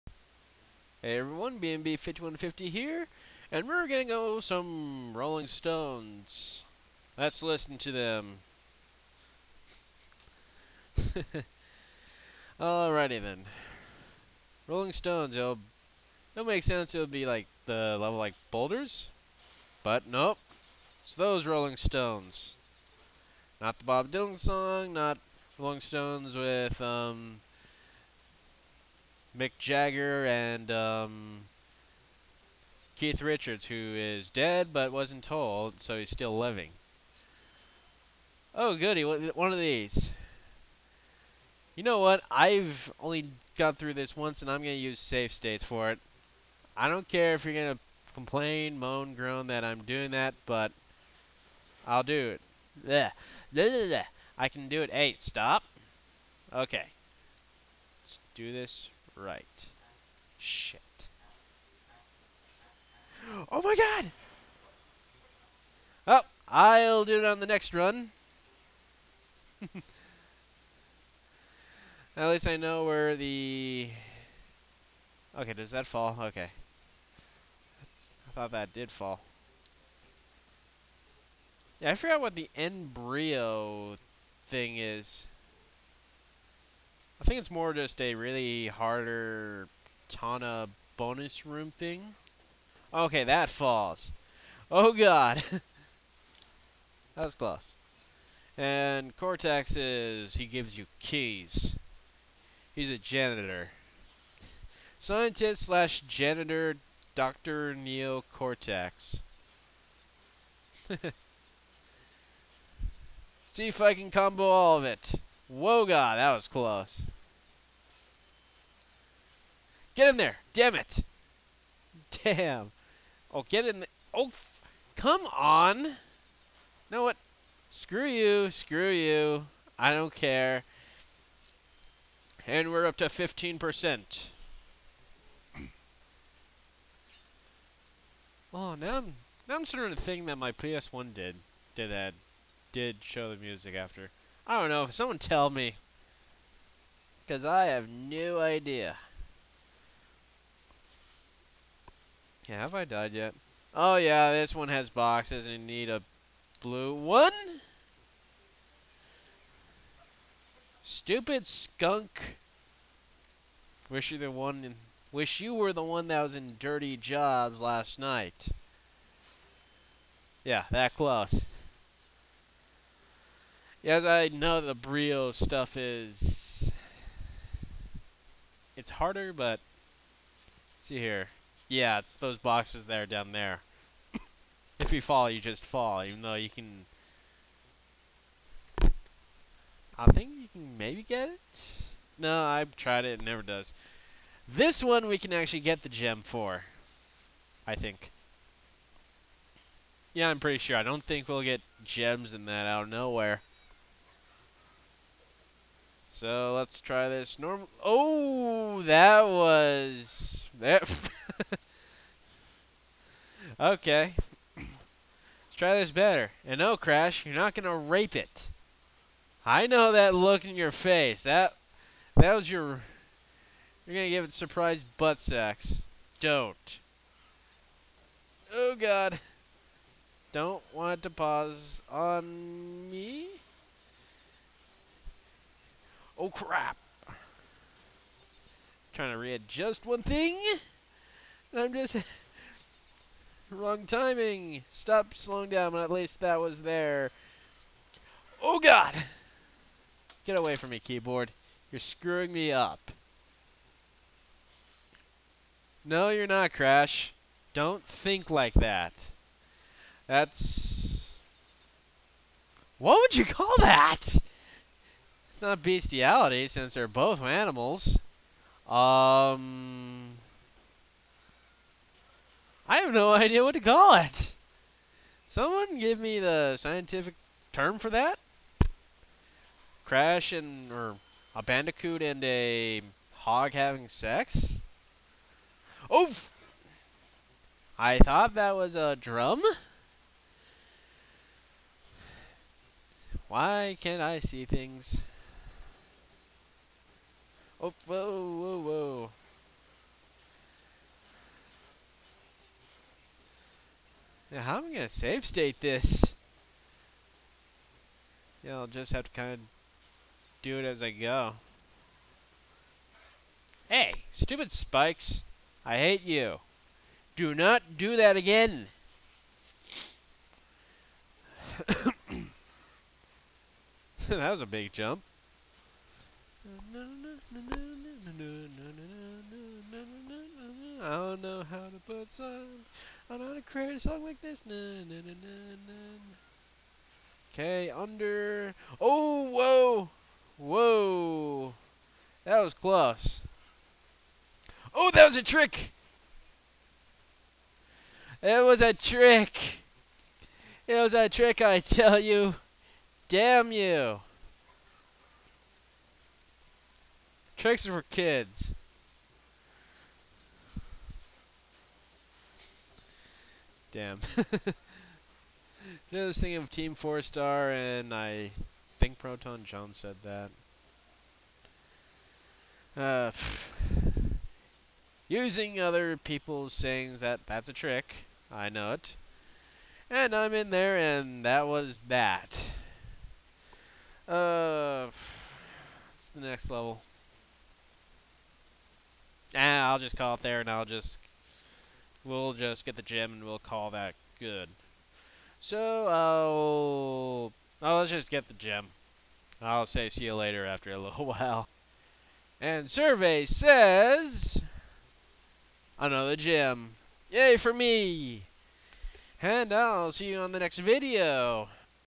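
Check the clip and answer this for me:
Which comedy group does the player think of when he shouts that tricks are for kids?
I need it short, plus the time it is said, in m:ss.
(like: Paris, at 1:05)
Team Four Star, at 6:06.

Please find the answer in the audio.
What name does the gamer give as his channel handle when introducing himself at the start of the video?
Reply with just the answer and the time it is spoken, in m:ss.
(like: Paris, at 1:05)
BNB5150, at 0:01.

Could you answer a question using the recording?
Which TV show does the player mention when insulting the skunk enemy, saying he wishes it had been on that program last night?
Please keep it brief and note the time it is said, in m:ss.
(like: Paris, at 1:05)
Dirty Jobs, at 2:46.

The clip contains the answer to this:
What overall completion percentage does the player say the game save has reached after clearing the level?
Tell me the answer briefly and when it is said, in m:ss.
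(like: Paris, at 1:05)
15%, at 2:13.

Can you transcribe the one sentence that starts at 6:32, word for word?
We'll just get the gem, and we'll call that good.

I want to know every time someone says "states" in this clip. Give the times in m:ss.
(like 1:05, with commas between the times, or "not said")
0:45, 5:05.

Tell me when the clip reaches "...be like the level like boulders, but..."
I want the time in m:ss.
0:17.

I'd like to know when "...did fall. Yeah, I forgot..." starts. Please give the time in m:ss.
1:18.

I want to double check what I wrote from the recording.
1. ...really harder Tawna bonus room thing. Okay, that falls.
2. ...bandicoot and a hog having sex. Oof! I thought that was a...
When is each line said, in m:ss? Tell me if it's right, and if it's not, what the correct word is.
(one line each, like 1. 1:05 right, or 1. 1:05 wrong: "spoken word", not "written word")
1. 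1:28 right
2. 4:41 right.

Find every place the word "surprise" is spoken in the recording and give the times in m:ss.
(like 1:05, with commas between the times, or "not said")
3:44.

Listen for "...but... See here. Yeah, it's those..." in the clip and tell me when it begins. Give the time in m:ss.
2:59.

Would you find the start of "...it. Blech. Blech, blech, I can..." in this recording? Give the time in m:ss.
0:52.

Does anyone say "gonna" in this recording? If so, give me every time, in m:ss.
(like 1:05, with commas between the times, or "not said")
0:03, 3:37, 3:43.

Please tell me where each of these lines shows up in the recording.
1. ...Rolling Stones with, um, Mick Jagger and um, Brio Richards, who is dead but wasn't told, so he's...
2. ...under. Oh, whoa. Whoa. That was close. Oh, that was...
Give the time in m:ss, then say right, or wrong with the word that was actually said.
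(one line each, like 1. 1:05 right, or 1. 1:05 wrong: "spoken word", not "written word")
1. 0:25 wrong: "Keith", not "Brio"
2. 5:37 right.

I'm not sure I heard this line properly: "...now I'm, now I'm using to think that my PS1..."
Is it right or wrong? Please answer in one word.
wrong.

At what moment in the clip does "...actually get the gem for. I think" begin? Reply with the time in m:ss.
3:15.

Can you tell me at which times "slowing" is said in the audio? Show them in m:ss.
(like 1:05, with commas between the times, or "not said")
4:05.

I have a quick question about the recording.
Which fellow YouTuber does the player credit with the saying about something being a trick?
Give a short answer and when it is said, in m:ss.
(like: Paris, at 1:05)
ProtonJon, at 6:08.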